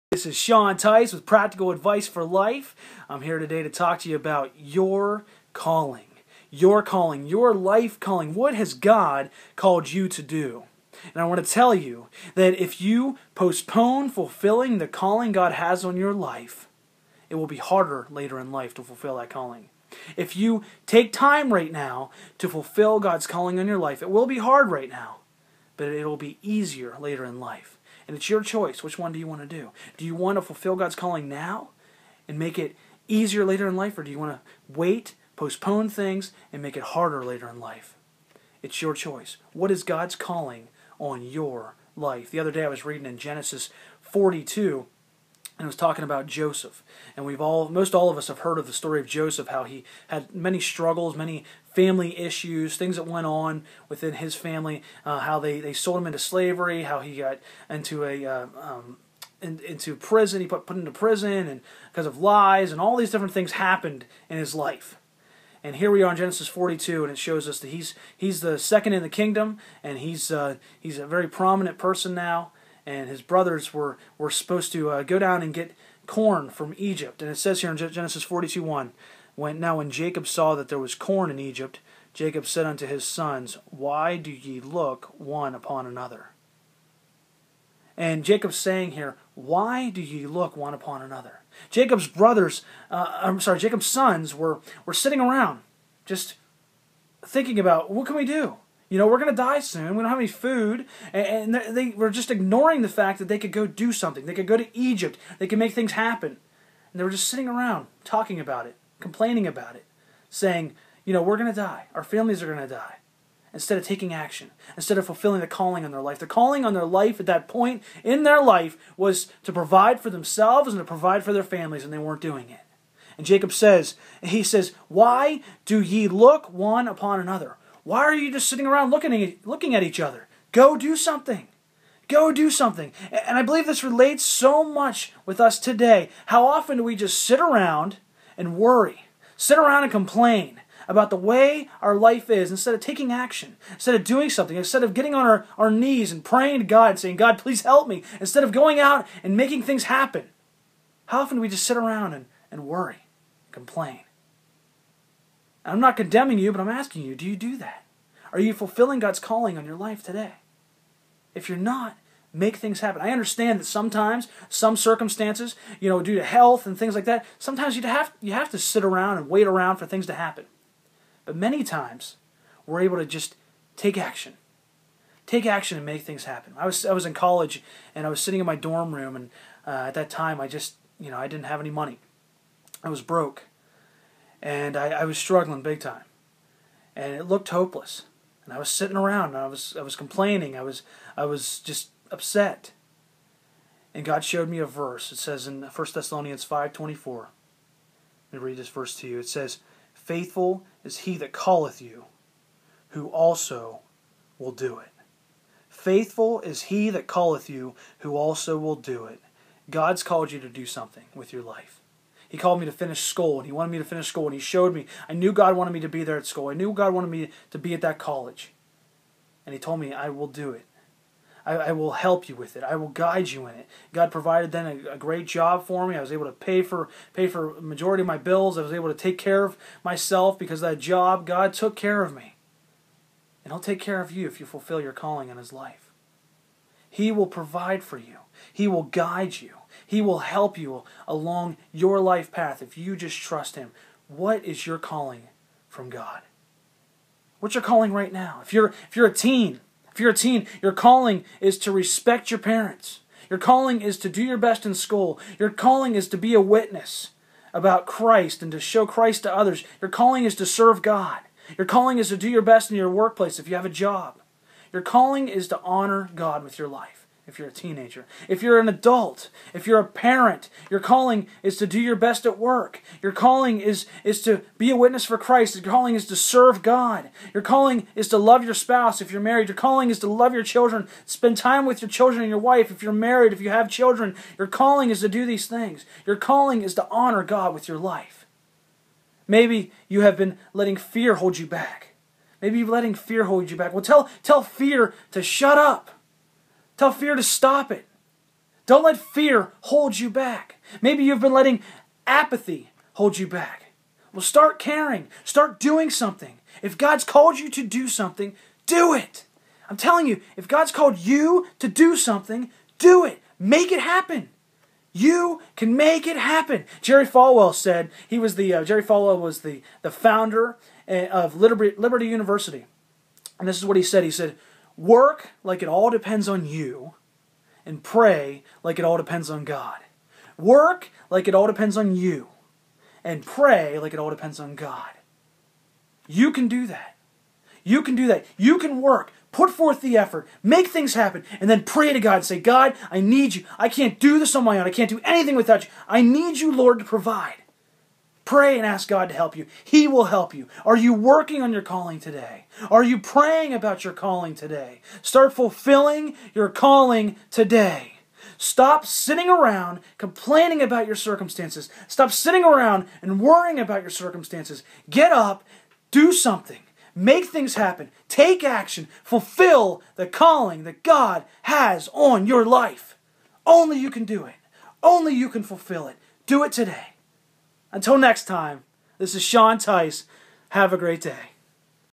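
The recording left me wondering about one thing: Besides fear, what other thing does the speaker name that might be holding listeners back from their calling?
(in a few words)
apathy.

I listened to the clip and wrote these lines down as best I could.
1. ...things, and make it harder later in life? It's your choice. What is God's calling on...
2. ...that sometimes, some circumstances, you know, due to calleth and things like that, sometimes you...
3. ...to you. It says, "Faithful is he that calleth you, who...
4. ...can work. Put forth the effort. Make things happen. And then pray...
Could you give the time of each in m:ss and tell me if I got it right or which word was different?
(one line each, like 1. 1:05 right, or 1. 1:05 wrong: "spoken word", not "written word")
1. 0:35 right
2. 2:43 wrong: "health", not "calleth"
3. 3:18 right
4. 5:38 right.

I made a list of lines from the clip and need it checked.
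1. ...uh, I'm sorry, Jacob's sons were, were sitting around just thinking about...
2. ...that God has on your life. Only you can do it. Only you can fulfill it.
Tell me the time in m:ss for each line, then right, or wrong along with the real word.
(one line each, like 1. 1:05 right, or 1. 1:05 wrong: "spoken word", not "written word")
1. 1:32 right
2. 6:10 right.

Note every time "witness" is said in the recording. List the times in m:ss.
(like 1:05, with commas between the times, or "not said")
4:16, 4:34.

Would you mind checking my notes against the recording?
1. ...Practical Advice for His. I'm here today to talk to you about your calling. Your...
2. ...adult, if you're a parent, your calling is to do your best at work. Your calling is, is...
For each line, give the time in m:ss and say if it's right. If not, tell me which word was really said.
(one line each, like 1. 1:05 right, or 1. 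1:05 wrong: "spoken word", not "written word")
1. 0:01 wrong: "Life", not "His"
2. 4:28 right.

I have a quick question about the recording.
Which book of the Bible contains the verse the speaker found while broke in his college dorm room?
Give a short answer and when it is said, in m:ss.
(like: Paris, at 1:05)
1 Thessalonians, at 3:15.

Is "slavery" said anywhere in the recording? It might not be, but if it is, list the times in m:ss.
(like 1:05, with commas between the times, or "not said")
0:56.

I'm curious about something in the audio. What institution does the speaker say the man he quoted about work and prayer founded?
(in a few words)
Liberty University.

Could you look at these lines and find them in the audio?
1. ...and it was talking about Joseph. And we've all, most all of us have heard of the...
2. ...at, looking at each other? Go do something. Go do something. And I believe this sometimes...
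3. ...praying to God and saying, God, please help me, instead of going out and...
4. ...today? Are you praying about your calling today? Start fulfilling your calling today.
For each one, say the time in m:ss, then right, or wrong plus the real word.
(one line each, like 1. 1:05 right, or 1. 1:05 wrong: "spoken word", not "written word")
1. 0:45 right
2. 2:09 wrong: "relates", not "sometimes"
3. 2:26 right
4. 5:51 right.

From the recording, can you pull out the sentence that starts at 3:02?
I was broke and I, I was struggling big time, and it looked hopeless.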